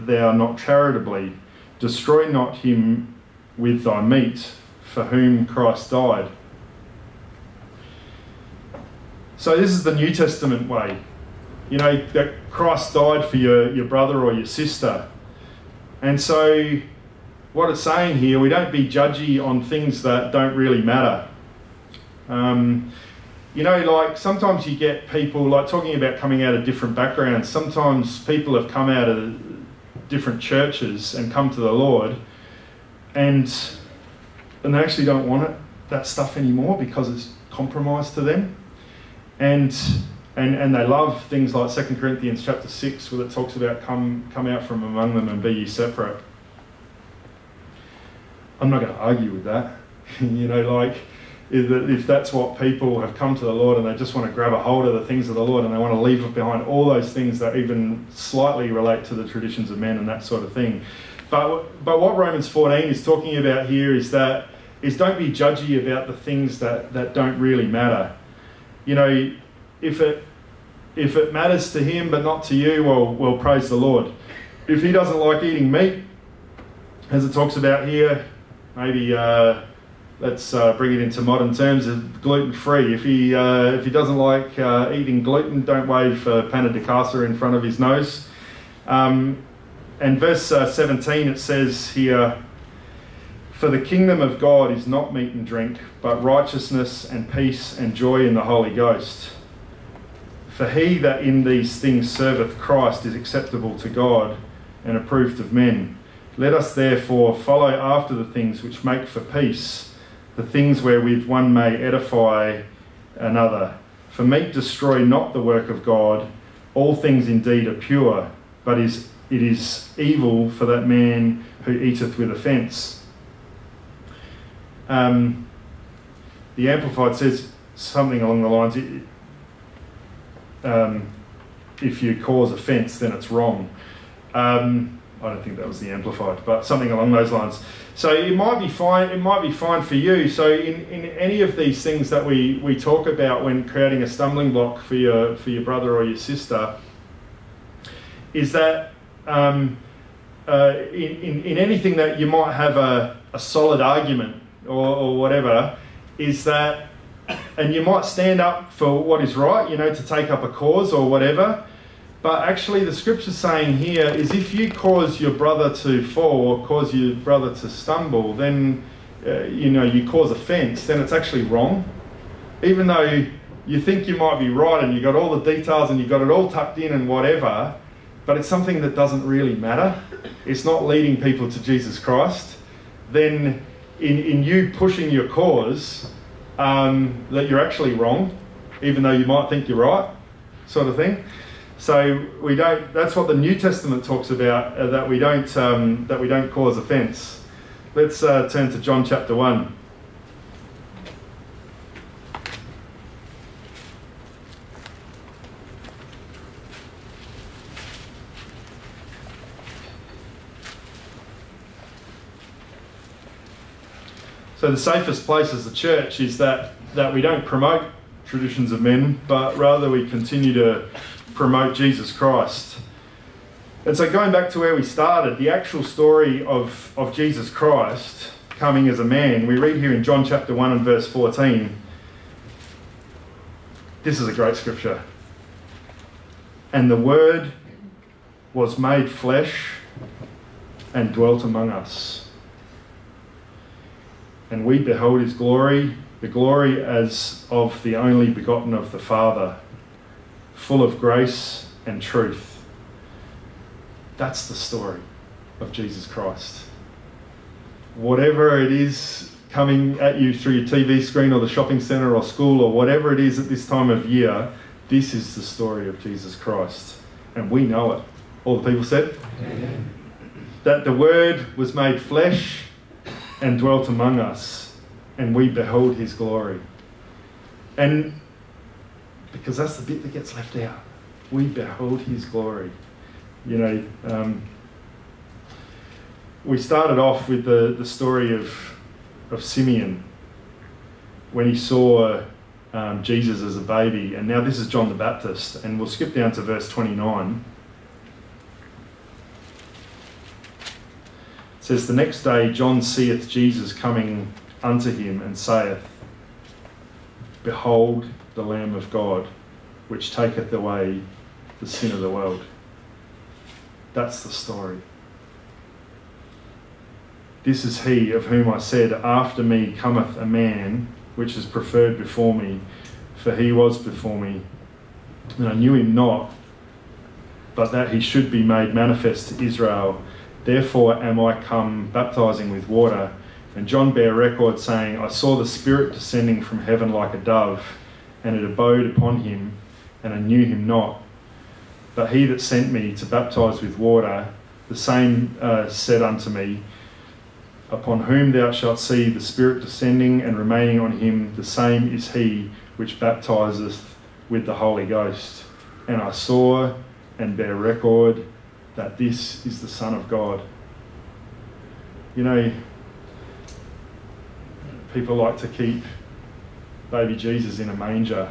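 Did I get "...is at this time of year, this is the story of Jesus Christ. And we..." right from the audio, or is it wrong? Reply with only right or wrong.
right.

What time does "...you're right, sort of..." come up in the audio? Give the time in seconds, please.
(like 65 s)
189 s.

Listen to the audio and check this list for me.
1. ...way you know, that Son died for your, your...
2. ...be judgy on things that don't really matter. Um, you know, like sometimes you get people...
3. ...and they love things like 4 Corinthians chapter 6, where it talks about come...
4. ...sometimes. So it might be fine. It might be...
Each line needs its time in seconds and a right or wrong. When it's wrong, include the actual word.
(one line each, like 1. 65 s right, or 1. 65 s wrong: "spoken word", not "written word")
1. 10 s wrong: "Christ", not "Son"
2. 18 s right
3. 40 s wrong: "2", not "4"
4. 137 s wrong: "lines", not "sometimes".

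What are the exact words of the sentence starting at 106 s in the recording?
Let us therefore follow after the things which make for peace, the things wherewith one may edify another.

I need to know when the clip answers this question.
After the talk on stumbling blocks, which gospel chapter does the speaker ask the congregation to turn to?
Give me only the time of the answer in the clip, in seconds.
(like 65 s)
198 s.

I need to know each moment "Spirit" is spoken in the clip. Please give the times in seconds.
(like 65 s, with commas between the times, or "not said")
335 s, 349 s.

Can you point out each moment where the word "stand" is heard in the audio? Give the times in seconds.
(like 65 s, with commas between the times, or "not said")
158 s.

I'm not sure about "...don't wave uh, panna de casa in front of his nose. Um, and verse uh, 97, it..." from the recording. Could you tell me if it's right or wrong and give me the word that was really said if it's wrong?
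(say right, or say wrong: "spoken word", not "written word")
wrong: "17", not "97".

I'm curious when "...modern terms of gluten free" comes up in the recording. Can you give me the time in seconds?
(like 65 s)
81 s.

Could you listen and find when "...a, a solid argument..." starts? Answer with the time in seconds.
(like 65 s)
152 s.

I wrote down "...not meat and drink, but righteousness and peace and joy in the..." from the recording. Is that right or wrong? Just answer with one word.
right.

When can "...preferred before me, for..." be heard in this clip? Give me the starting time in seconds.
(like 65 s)
321 s.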